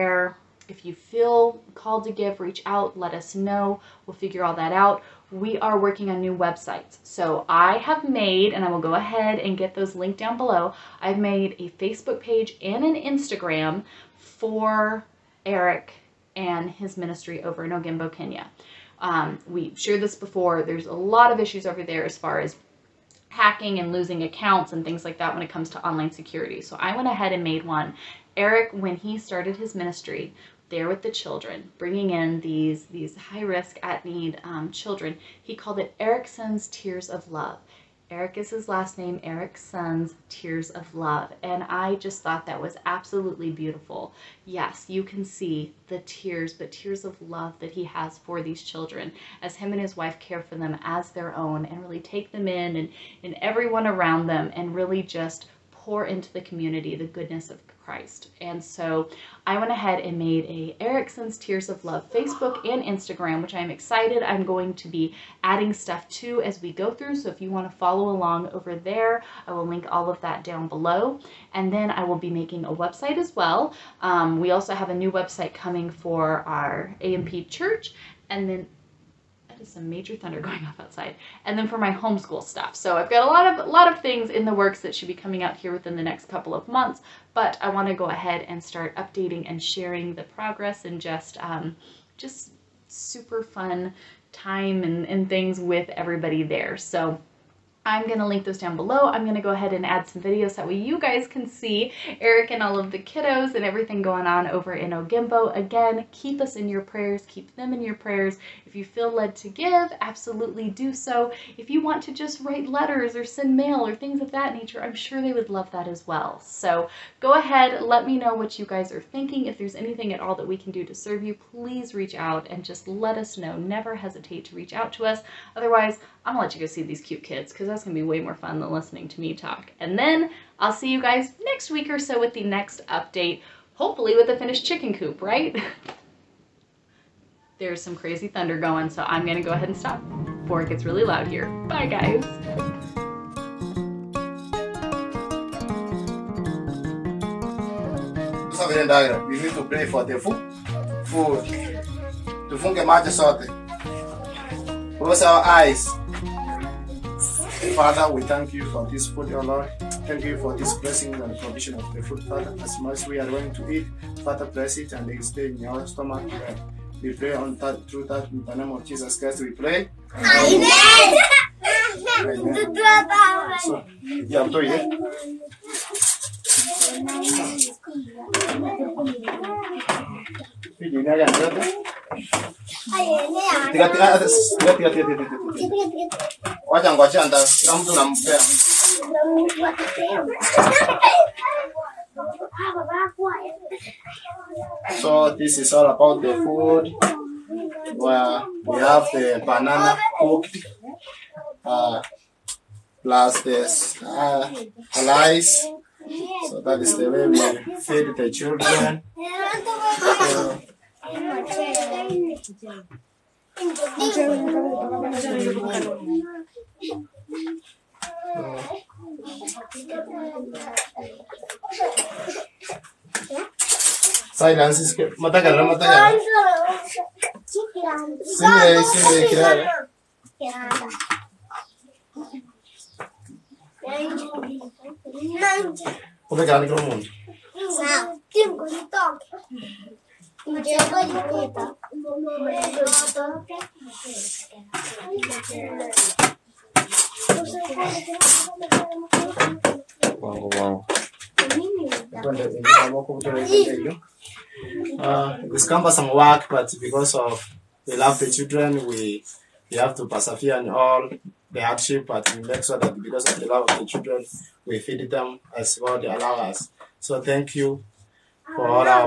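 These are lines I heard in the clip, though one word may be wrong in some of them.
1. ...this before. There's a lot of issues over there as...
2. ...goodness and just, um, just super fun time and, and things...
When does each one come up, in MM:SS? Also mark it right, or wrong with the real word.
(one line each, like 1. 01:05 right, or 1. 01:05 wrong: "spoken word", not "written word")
1. 00:20 right
2. 01:30 wrong: "progress", not "goodness".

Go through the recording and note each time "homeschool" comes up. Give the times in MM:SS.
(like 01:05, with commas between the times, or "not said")
01:21.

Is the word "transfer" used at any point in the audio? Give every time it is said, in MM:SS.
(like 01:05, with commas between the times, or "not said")
not said.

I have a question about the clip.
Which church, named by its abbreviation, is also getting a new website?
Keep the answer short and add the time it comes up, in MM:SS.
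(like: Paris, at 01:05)
A&P church, at 01:16.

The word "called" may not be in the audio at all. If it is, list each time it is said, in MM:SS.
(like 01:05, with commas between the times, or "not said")
00:01, 00:35.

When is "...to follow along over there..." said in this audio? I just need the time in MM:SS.
01:07.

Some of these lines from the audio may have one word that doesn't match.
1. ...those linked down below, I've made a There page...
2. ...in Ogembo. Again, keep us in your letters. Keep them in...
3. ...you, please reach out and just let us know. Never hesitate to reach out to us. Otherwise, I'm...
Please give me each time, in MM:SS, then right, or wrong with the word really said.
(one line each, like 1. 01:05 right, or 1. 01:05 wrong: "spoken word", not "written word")
1. 00:09 wrong: "Facebook", not "There"
2. 01:44 wrong: "prayers", not "letters"
3. 02:01 right.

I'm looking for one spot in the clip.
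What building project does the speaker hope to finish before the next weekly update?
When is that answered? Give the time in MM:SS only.
02:14.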